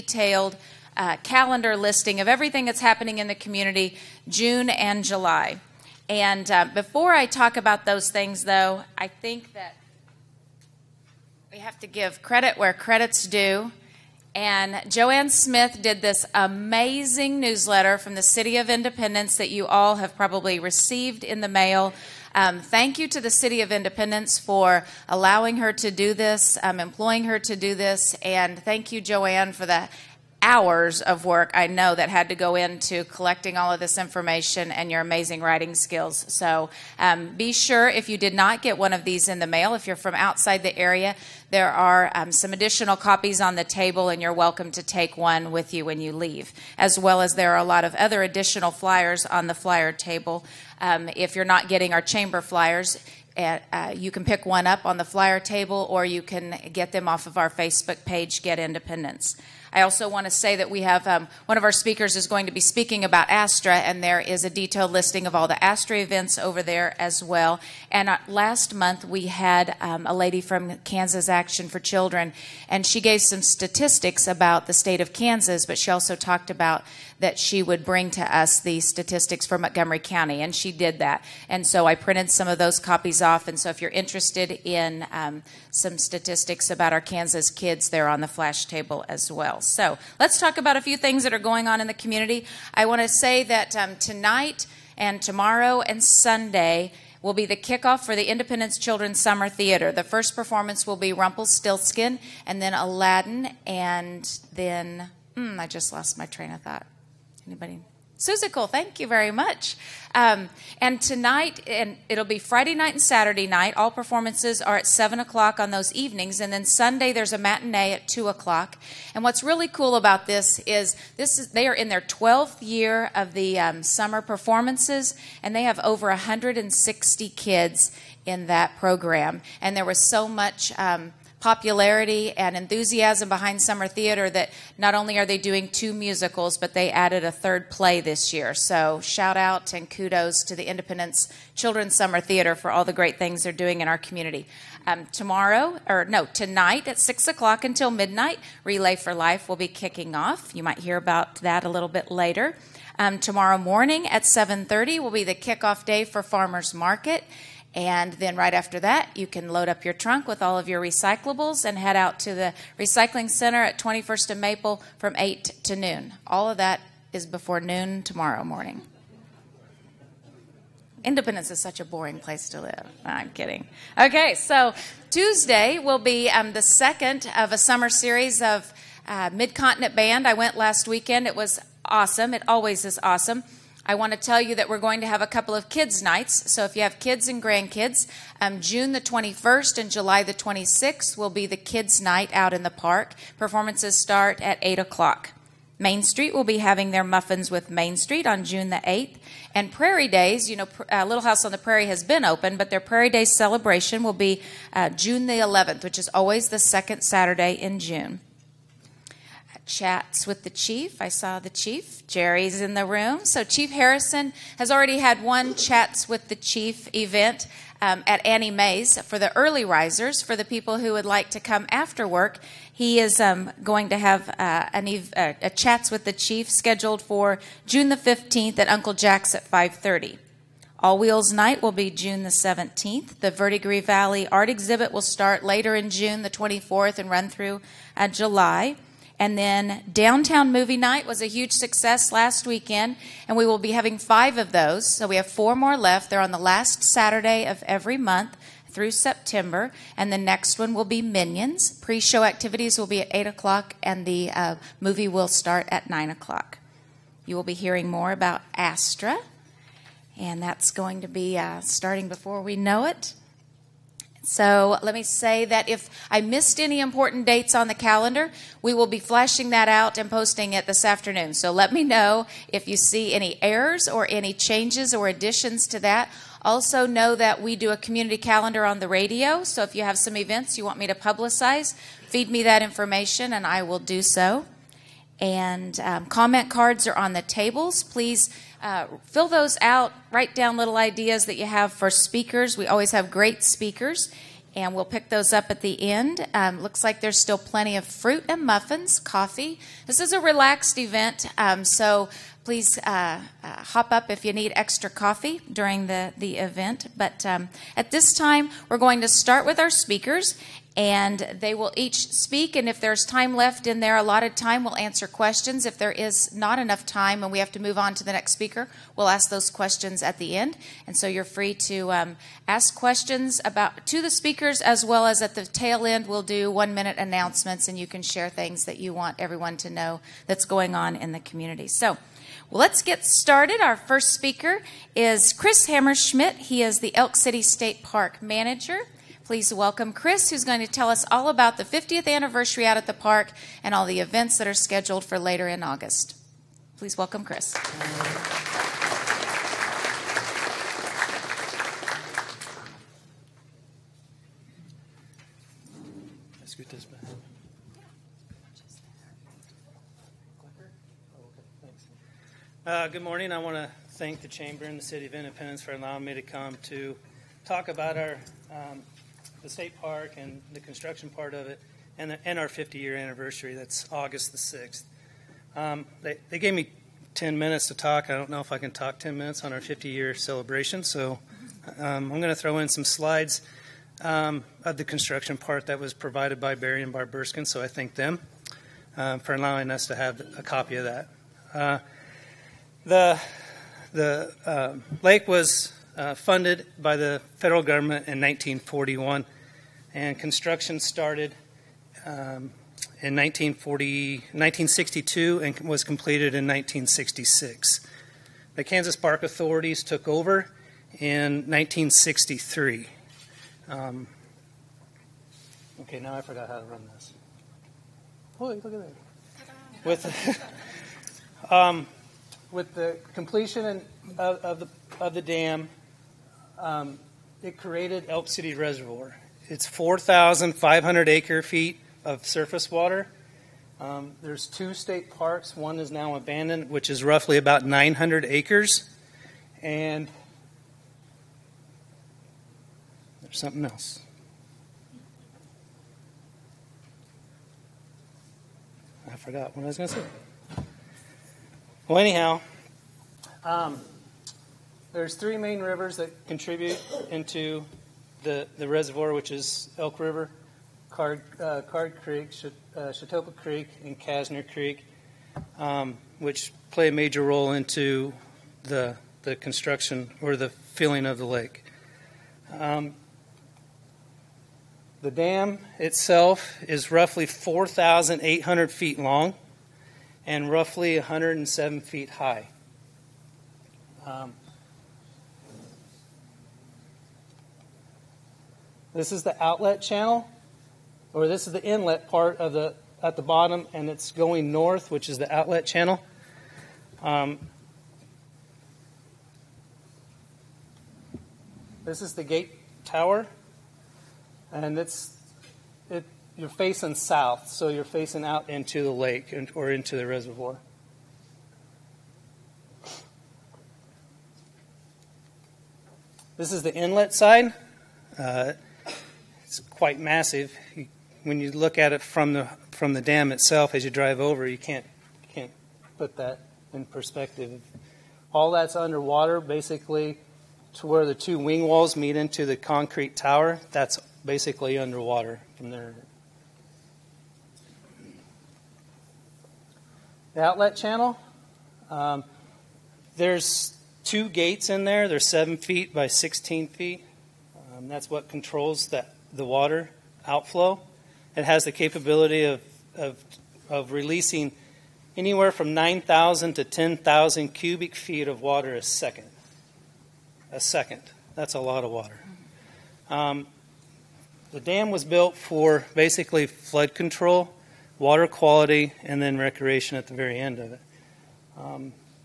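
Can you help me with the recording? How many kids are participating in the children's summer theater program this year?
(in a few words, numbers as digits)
over 160.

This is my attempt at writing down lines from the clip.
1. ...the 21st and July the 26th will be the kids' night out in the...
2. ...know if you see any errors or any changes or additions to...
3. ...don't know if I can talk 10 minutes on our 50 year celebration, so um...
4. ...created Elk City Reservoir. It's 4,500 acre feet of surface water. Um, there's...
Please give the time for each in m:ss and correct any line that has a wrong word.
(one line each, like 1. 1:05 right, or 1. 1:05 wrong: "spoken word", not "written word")
1. 3:08 right
2. 4:31 right
3. 6:18 right
4. 7:07 right.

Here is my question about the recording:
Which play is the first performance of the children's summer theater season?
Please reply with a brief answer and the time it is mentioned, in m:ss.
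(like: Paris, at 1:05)
Rumpelstiltskin, at 1:41.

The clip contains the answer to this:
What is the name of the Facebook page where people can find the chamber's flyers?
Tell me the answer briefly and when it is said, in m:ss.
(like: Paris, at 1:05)
Get Independence, at 0:58.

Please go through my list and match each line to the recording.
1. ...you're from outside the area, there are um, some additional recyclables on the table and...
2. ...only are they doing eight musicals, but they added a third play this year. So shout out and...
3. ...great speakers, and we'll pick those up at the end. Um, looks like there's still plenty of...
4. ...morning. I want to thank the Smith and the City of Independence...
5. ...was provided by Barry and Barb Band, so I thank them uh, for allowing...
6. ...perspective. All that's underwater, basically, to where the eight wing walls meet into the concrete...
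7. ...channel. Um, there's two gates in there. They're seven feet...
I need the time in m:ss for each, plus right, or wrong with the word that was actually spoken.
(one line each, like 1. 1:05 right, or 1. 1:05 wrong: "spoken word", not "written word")
1. 0:39 wrong: "copies", not "recyclables"
2. 2:14 wrong: "two", not "eight"
3. 4:53 right
4. 6:03 wrong: "Chamber", not "Smith"
5. 6:25 wrong: "Burskin", not "Band"
6. 8:46 wrong: "two", not "eight"
7. 9:00 right.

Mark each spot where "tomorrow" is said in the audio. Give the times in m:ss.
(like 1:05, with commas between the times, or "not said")
1:35, 2:25, 2:33, 2:48.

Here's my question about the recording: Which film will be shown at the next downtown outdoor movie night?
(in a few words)
Minions.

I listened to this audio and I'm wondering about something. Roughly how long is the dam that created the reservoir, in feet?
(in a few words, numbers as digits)
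4,800 feet.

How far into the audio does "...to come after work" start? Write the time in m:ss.
3:41.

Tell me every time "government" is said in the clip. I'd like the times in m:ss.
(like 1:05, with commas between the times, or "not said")
6:37.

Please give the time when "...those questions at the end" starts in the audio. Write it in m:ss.
5:19.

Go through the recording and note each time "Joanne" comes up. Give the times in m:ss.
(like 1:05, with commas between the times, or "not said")
0:14, 0:28.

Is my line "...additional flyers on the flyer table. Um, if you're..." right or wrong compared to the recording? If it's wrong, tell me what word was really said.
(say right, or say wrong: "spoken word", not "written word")
right.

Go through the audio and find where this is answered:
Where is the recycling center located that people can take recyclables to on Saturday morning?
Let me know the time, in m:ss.
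2:43.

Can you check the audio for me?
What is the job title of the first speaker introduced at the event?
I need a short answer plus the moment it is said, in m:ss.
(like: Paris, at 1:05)
Elk City State Park Manager, at 5:36.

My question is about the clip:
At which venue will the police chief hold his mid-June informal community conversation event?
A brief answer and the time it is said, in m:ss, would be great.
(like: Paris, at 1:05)
Uncle Jack's, at 3:48.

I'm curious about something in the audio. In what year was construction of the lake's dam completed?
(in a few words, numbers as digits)
1966.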